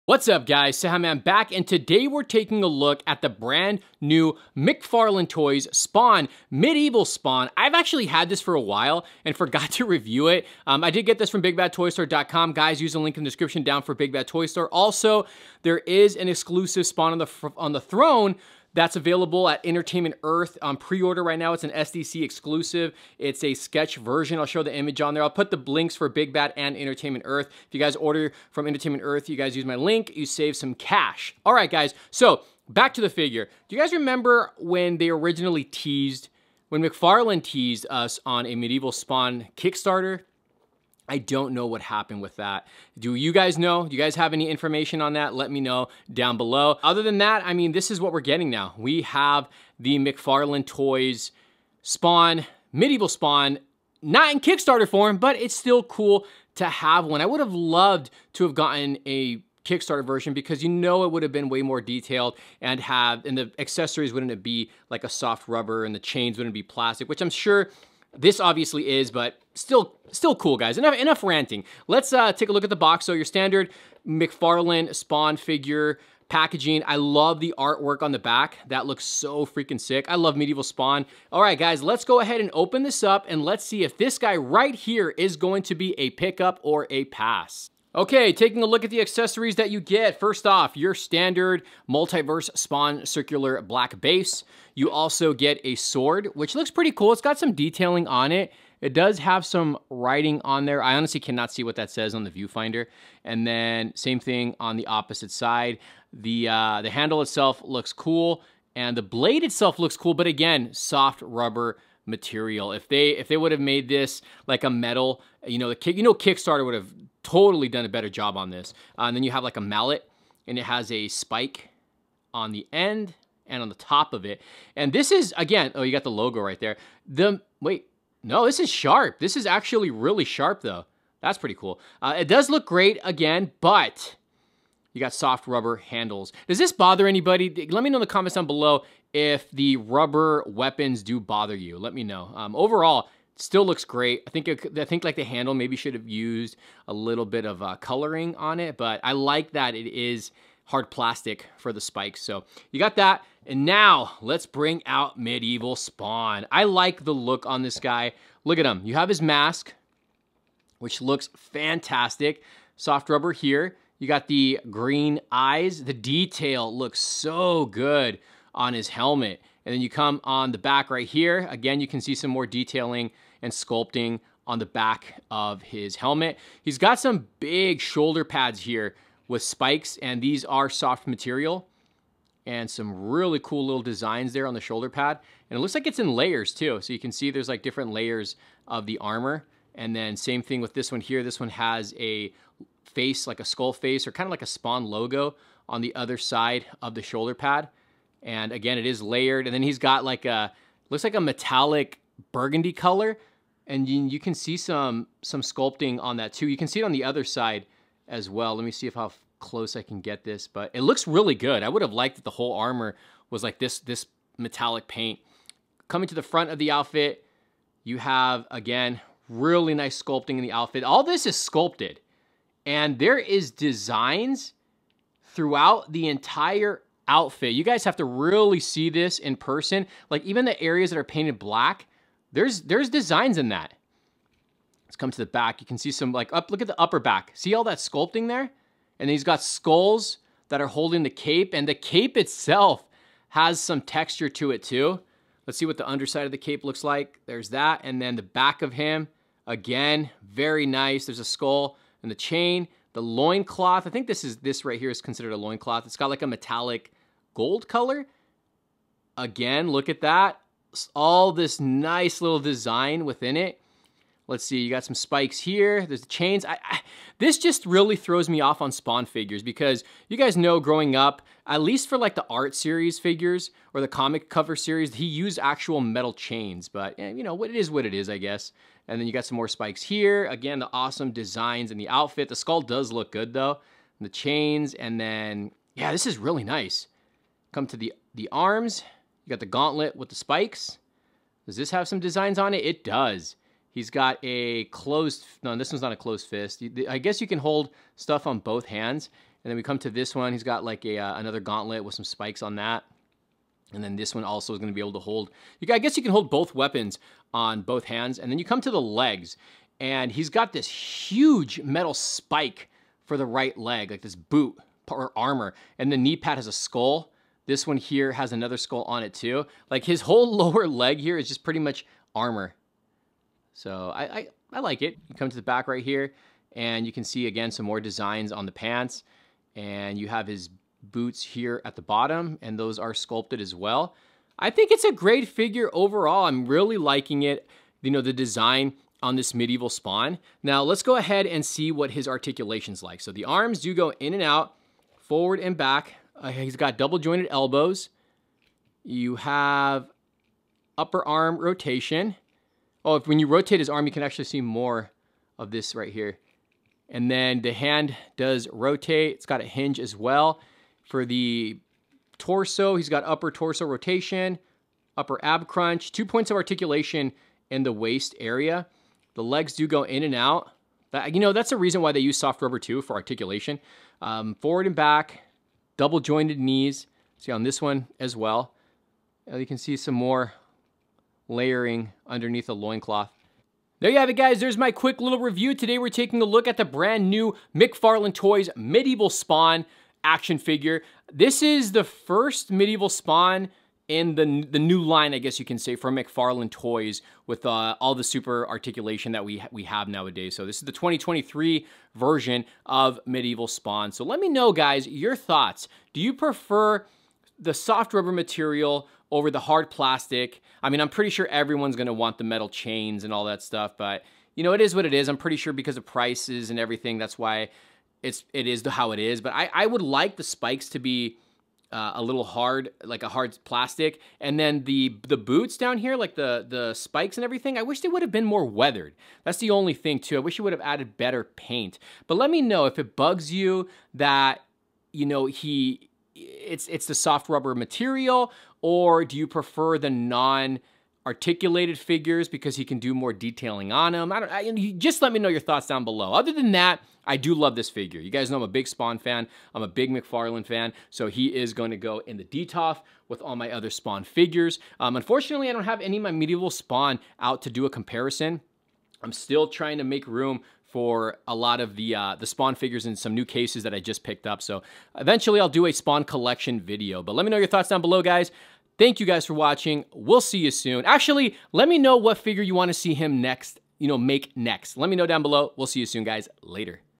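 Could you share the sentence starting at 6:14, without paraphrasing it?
Um, forward and back, double jointed knees.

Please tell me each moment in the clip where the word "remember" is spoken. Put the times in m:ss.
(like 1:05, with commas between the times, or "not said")
0:33.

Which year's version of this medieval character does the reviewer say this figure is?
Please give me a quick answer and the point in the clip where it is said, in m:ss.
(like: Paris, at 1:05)
2023, at 6:40.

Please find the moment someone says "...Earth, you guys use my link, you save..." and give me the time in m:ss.
0:29.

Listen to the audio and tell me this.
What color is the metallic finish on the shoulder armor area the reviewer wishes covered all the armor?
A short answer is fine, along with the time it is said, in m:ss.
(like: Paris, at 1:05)
Burgundy, at 3:21.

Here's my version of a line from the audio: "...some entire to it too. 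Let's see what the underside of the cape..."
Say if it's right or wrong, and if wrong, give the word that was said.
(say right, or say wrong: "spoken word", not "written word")
wrong: "texture", not "entire".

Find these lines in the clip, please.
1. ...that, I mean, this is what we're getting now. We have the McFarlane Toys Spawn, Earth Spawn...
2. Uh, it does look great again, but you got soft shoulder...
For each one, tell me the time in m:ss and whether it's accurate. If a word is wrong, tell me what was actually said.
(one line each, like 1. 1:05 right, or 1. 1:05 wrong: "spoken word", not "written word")
1. 0:47 wrong: "Medieval", not "Earth"
2. 2:12 wrong: "rubber", not "shoulder".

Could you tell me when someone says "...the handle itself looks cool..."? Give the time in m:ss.
1:46.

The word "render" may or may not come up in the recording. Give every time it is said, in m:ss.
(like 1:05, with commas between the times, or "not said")
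not said.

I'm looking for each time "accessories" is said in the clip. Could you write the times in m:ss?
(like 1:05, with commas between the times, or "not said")
1:03, 1:29.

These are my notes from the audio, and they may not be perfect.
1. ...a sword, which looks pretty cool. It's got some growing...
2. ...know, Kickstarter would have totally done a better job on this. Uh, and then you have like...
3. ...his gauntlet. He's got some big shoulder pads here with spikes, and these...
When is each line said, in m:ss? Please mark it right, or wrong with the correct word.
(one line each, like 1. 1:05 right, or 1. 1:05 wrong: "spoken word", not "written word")
1. 1:35 wrong: "detailing", not "growing"
2. 1:56 right
3. 2:55 wrong: "helmet", not "gauntlet".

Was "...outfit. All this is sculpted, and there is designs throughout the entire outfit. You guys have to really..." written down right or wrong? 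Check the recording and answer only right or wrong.
right.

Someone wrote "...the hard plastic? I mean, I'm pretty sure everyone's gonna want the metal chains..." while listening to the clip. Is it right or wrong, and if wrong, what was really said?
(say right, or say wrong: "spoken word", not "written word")
right.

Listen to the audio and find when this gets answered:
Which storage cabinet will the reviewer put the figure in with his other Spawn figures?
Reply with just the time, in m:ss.
7:32.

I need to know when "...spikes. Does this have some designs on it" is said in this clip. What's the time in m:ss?
4:50.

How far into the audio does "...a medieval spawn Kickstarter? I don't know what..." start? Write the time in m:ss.
0:38.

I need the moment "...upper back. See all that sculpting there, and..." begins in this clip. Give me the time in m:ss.
3:56.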